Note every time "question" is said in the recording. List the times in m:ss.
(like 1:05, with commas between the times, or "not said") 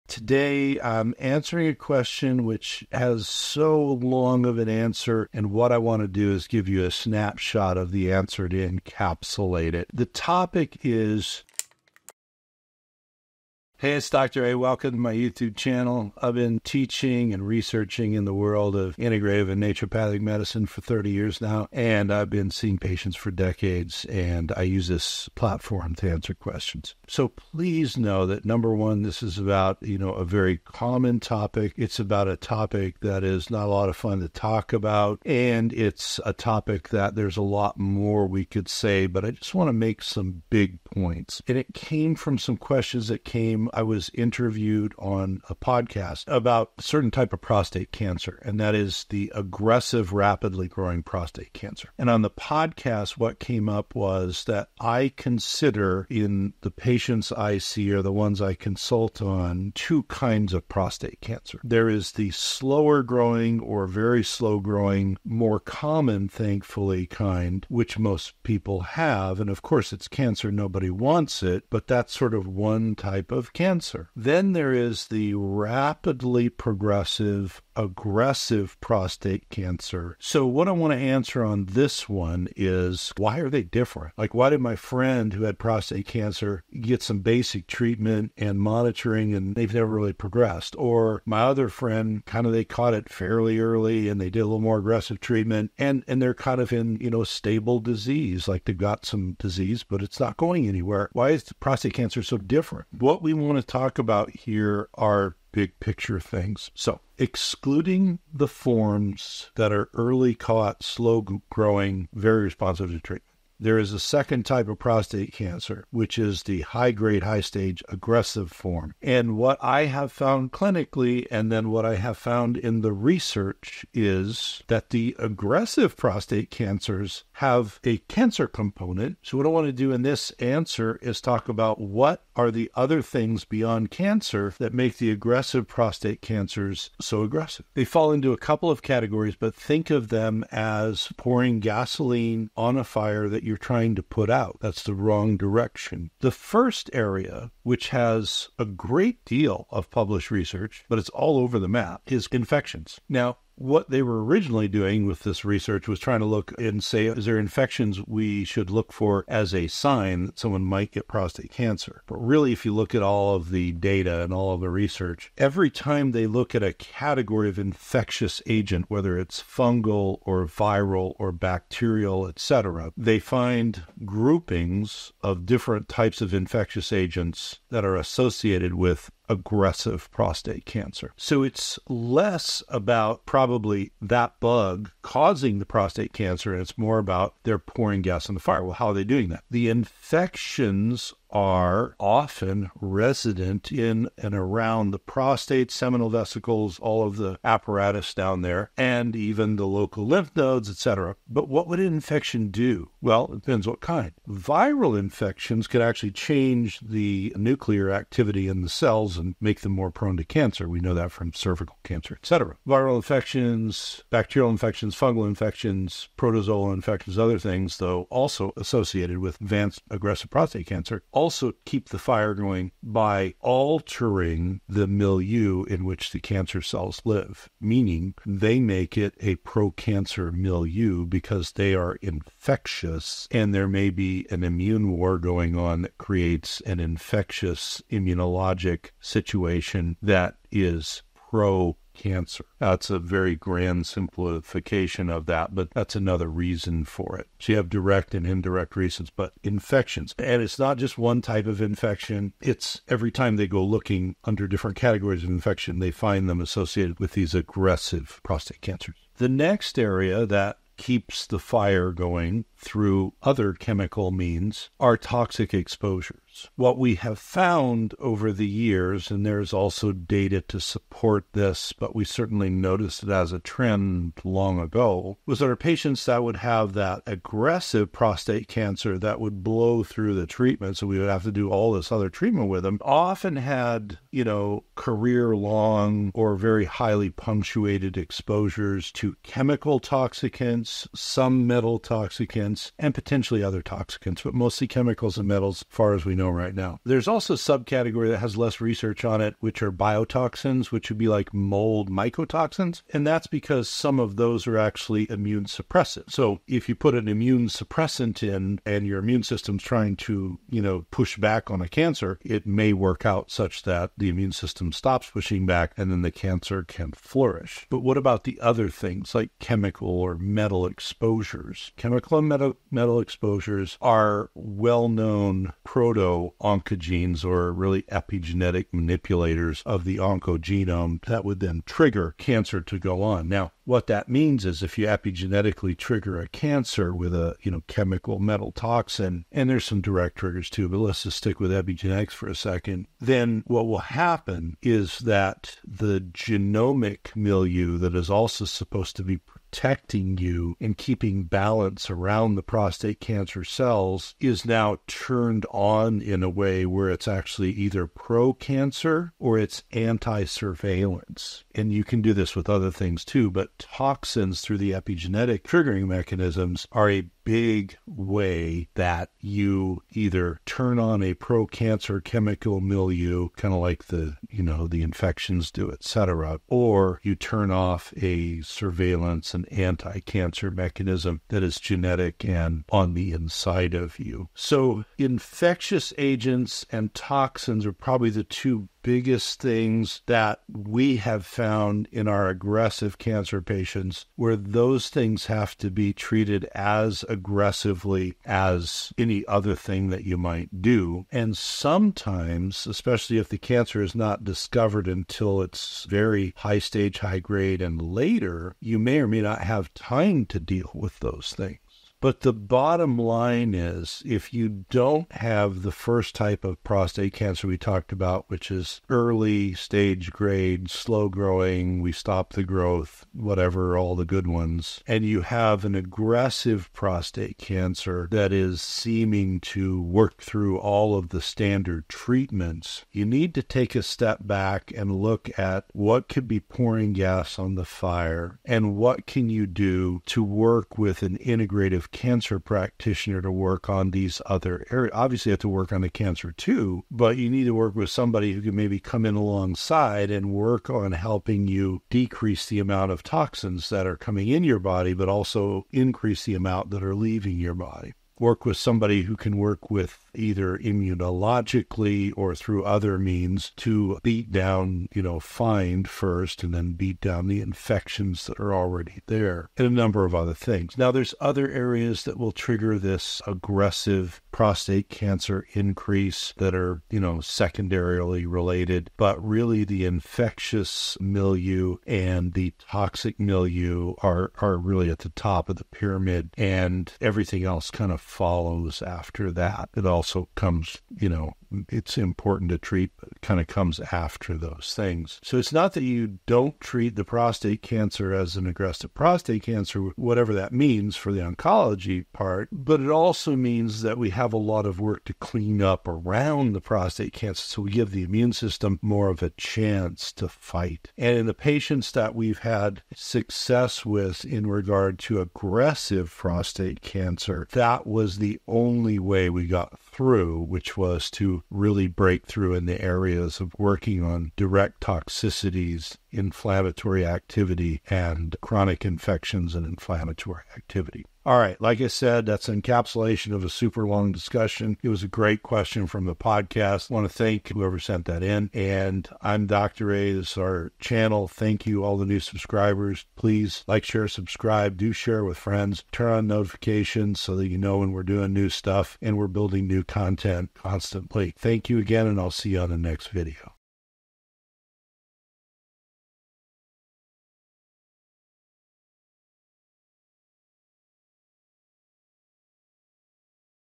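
0:01, 0:26, 0:42, 8:55.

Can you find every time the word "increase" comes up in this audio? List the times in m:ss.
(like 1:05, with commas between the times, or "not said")
7:35, 7:55.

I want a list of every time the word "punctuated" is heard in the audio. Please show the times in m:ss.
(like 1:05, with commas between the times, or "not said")
4:47.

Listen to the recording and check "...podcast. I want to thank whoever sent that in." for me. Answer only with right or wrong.
right.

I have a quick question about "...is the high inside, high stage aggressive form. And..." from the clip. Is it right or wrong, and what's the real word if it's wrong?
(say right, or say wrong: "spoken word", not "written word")
wrong: "grade", not "inside".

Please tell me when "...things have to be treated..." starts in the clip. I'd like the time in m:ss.
6:34.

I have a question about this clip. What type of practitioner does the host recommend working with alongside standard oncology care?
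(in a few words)
Integrative cancer practitioner.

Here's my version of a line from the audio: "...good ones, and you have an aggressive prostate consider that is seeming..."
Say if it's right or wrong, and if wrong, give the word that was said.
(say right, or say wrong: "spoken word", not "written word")
wrong: "cancer", not "consider".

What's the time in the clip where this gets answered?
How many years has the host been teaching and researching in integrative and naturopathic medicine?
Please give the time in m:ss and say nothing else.
0:20.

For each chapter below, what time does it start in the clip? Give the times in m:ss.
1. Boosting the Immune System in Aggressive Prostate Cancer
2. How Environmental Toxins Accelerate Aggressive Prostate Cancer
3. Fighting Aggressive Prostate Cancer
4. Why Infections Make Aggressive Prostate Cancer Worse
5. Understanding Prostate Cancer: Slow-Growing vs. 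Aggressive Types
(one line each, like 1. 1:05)
1. 7:50
2. 4:18
3. 6:51
4. 1:42
5. 0:52.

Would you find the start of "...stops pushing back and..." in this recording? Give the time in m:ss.
5:14.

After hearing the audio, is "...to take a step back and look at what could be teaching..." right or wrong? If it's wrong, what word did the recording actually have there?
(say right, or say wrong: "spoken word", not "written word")
wrong: "pouring", not "teaching".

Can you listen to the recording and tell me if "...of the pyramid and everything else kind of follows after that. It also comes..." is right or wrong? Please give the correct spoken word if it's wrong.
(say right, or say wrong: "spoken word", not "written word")
right.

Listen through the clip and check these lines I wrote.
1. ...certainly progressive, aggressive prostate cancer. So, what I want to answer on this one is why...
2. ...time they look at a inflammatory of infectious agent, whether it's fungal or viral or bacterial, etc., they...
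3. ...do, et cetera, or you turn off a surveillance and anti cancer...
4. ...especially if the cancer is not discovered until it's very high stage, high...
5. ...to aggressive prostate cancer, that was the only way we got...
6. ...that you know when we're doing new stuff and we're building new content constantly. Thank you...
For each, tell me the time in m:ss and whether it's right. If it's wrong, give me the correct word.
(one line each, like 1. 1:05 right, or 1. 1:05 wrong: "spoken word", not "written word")
1. 1:15 wrong: "rapidly", not "certainly"
2. 2:45 wrong: "category", not "inflammatory"
3. 6:15 right
4. 6:42 right
5. 8:34 right
6. 9:07 right.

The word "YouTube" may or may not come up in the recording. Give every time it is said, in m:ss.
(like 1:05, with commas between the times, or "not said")
0:15.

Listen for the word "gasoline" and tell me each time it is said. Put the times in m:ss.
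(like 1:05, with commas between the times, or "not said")
2:21.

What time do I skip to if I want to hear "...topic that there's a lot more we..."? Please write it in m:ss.
0:36.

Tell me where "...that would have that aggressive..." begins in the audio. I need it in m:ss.
4:36.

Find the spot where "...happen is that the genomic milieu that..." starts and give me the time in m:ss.
5:43.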